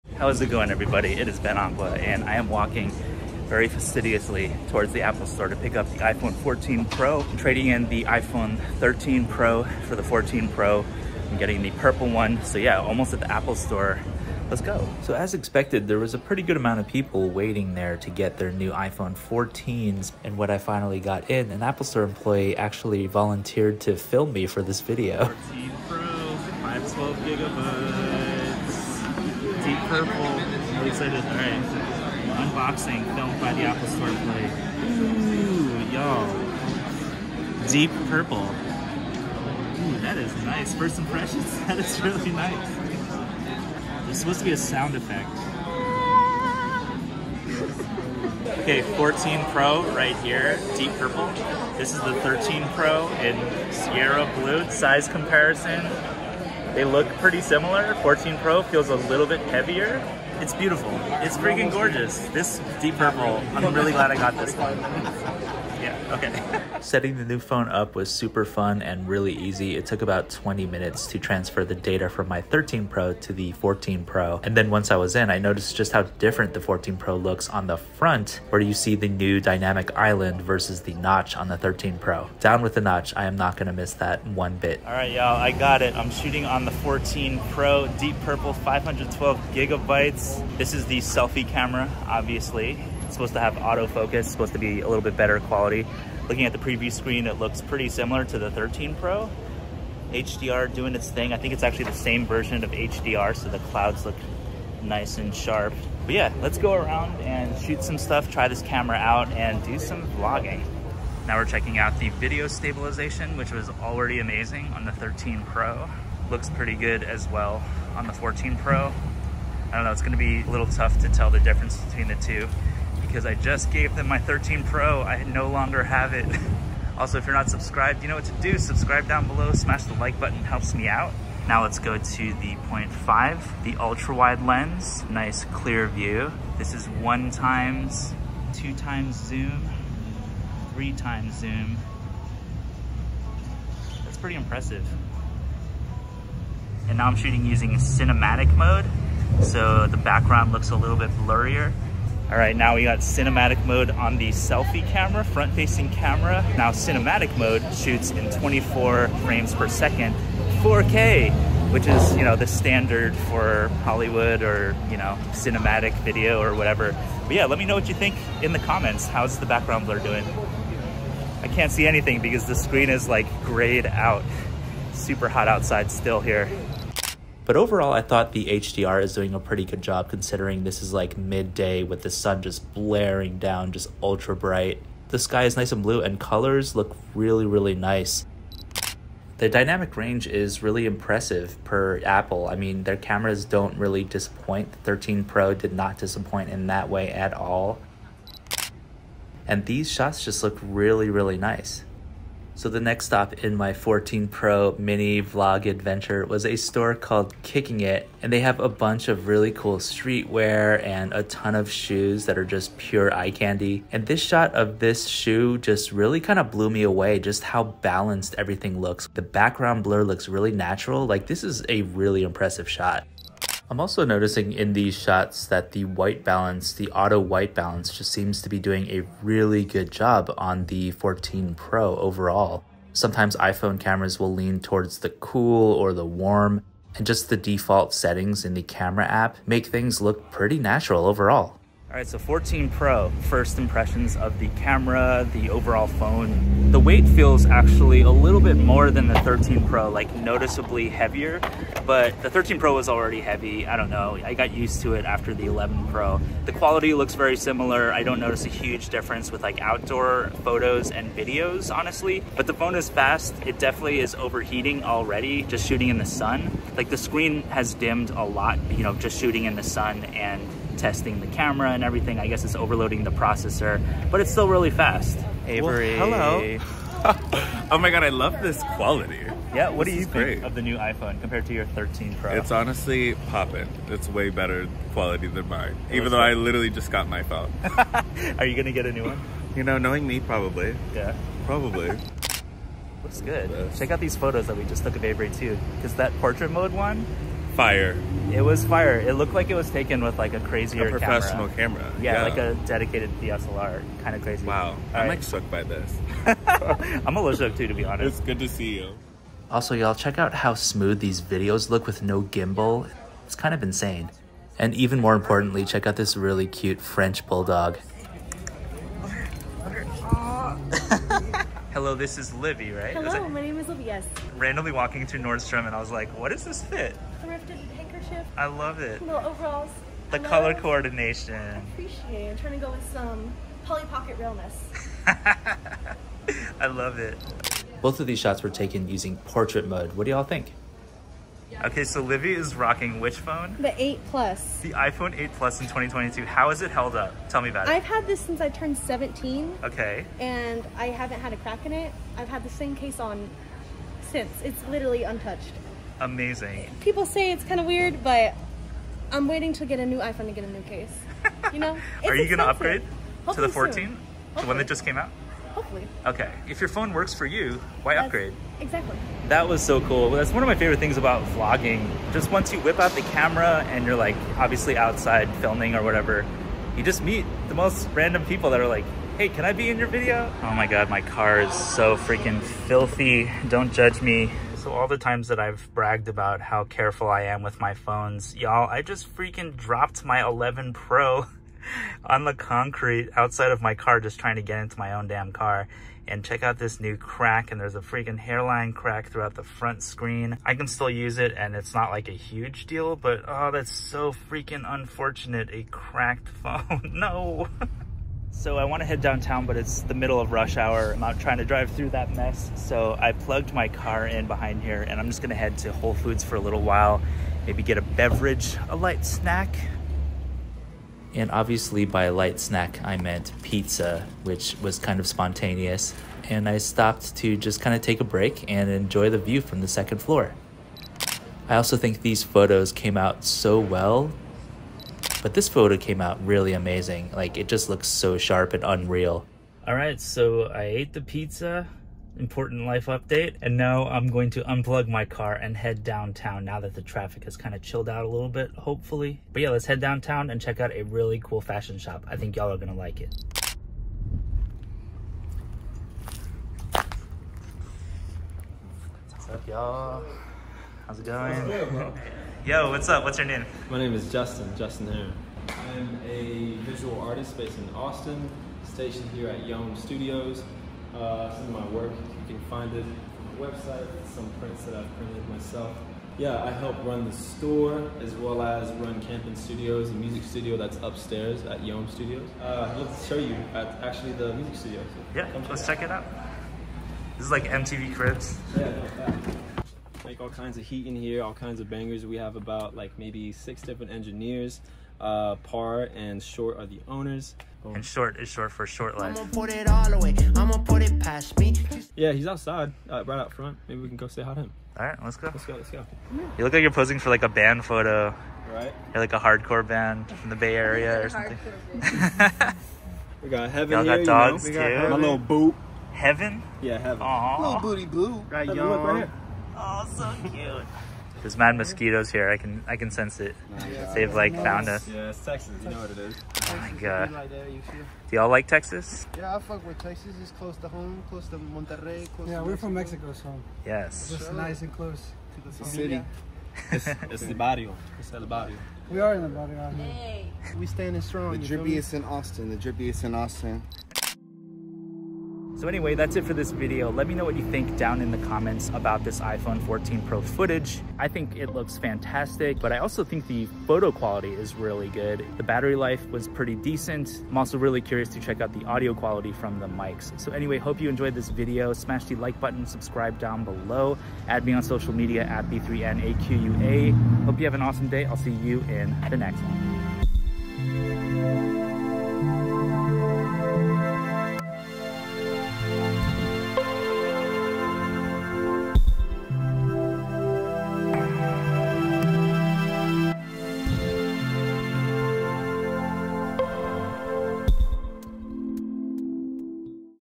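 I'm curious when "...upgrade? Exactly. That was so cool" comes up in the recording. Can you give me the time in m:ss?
6:08.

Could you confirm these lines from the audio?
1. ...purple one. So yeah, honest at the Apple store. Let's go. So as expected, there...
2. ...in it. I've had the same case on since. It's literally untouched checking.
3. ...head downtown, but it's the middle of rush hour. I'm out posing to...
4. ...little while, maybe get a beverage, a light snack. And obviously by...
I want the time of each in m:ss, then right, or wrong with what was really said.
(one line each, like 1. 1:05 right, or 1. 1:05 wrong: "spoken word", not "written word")
1. 0:11 wrong: "almost", not "honest"
2. 5:51 wrong: "amazing", not "checking"
3. 6:48 wrong: "trying", not "posing"
4. 6:56 right.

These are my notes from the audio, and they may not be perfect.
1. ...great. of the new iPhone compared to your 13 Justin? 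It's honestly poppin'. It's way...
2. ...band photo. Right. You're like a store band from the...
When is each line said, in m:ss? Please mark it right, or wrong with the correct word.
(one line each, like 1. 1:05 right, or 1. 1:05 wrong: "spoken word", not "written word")
1. 4:40 wrong: "Pro", not "Justin"
2. 8:27 wrong: "hardcore", not "store".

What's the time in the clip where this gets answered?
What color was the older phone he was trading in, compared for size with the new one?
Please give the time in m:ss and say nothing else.
0:53.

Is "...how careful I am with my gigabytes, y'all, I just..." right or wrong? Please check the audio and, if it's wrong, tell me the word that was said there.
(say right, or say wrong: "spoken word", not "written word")
wrong: "phones", not "gigabytes".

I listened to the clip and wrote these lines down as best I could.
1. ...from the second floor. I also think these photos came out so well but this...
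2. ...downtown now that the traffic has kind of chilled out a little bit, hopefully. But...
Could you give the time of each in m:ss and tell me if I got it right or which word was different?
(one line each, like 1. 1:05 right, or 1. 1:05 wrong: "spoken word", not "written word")
1. 7:09 right
2. 7:25 right.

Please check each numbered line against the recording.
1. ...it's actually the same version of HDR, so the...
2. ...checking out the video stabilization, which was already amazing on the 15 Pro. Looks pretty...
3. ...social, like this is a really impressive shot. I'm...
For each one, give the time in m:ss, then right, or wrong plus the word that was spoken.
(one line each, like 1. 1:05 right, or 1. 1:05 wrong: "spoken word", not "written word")
1. 1:41 right
2. 1:51 wrong: "13", not "15"
3. 3:40 wrong: "natural", not "social".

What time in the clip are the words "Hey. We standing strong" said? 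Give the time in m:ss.
8:59.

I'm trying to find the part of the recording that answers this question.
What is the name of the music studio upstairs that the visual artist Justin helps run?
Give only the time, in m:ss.
7:59.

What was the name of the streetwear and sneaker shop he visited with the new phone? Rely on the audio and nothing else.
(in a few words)
Kicking It.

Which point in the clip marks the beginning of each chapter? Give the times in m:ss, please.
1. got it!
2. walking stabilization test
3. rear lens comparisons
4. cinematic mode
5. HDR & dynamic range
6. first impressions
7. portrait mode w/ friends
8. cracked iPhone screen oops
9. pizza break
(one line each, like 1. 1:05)
1. 1:25
2. 1:51
3. 2:12
4. 2:27
5. 2:56
6. 4:02
7. 4:35
8. 6:24
9. 6:48.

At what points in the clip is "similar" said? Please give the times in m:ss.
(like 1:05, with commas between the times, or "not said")
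0:57, 1:37, 4:17.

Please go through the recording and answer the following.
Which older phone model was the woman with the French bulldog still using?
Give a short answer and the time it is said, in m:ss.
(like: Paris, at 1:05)
iPhone 8 Plus, at 5:44.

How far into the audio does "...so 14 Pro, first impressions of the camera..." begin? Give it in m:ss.
4:02.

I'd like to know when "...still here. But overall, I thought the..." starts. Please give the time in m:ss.
2:55.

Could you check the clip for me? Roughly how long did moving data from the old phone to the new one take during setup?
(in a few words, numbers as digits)
20 minutes.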